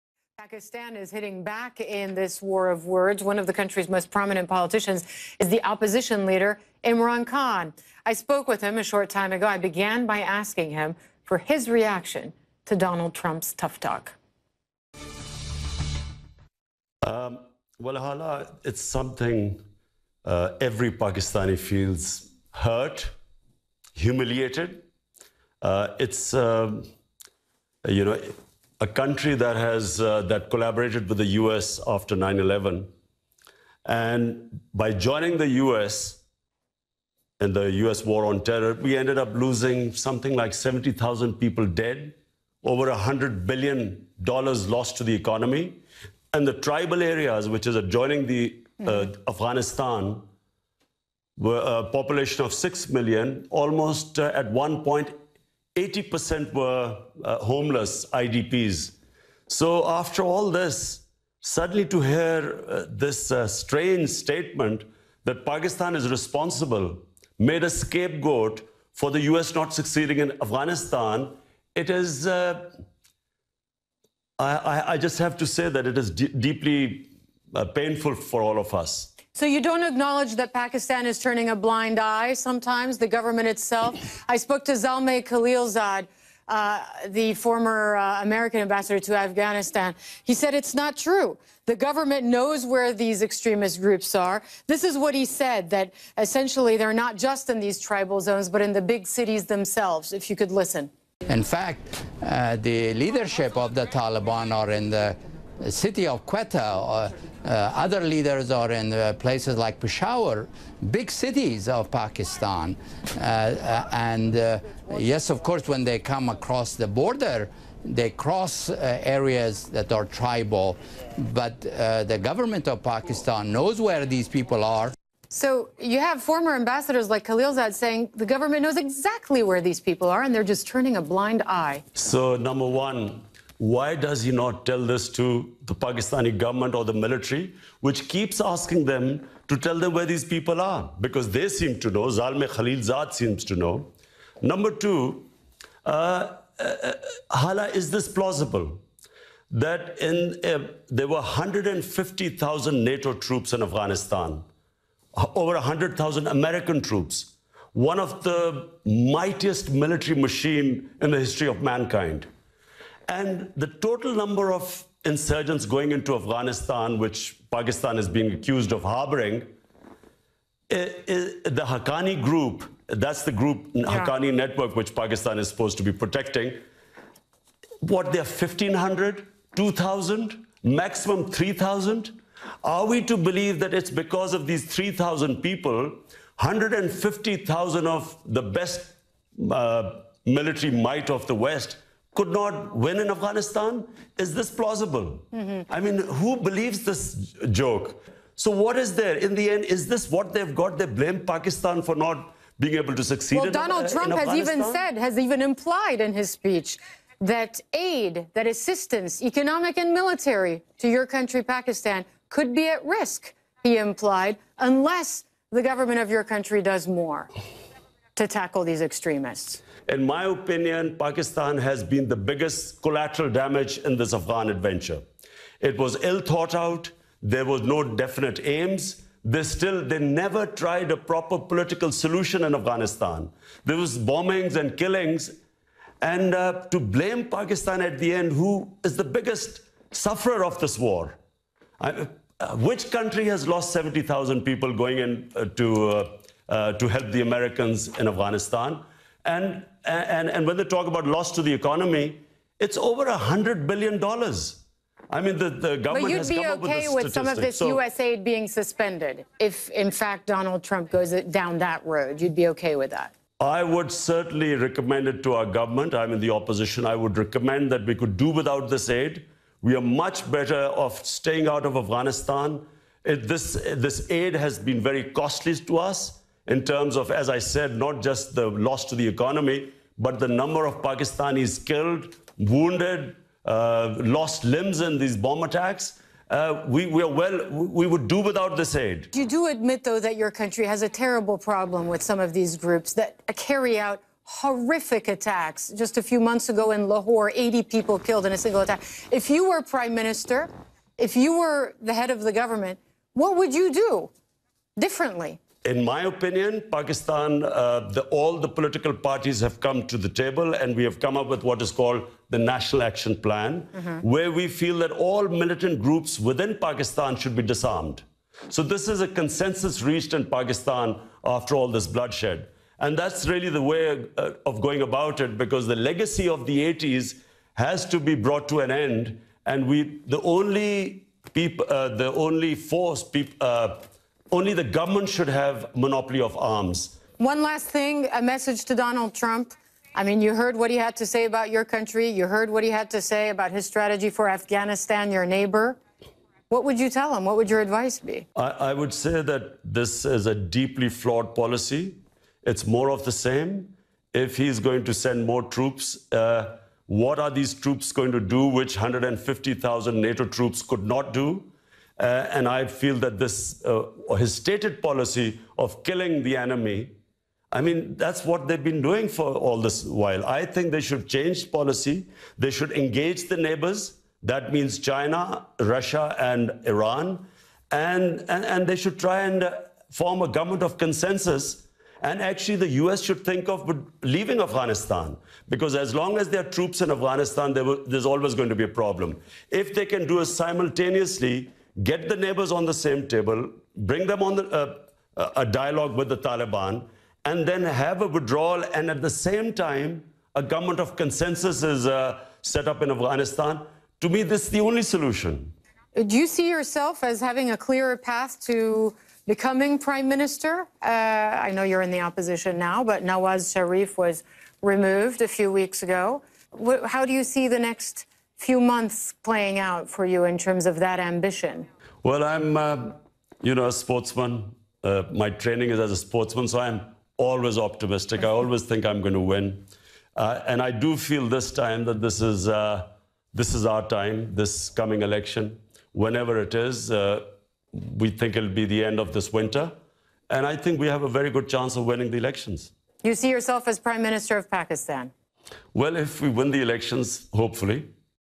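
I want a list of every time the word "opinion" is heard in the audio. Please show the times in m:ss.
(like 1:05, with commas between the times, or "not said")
3:40, 5:06.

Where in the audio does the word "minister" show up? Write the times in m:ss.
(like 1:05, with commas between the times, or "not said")
4:59, 6:50, 7:24.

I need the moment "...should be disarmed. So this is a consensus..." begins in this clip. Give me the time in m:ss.
5:17.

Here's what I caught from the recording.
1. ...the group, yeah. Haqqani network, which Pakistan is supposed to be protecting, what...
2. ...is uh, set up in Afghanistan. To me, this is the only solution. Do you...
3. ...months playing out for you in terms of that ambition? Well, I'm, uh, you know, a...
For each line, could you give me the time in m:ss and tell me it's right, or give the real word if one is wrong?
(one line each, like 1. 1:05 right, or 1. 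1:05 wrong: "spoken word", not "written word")
1. 2:53 right
2. 6:41 right
3. 6:58 right.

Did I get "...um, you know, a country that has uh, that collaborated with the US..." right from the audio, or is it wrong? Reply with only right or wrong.
right.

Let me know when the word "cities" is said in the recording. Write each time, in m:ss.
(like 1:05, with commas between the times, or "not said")
1:39, 1:51.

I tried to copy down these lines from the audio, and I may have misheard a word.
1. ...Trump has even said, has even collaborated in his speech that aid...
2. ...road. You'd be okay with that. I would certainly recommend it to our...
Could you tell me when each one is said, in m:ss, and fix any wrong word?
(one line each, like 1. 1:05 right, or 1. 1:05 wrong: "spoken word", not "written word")
1. 3:23 wrong: "implied", not "collaborated"
2. 4:21 right.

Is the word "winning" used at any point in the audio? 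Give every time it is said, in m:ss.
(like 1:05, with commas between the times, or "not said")
7:21.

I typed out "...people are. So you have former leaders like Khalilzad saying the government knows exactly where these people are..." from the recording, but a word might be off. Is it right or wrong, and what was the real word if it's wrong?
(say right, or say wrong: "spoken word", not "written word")
wrong: "ambassadors", not "leaders".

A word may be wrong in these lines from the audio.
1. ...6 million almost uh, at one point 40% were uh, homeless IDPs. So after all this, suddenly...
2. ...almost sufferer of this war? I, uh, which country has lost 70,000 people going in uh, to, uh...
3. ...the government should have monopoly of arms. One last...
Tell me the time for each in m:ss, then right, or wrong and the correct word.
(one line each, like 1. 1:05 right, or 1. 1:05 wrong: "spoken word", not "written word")
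1. 0:52 wrong: "80", not "40"
2. 3:59 wrong: "biggest", not "almost"
3. 5:34 right.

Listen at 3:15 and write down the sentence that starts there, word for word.
I mean, who believes this joke?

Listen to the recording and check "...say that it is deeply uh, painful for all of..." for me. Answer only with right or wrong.
right.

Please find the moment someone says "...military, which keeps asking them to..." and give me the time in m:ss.
2:16.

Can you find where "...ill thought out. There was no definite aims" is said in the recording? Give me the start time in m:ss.
3:46.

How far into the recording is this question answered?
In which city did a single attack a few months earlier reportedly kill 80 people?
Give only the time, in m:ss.
4:56.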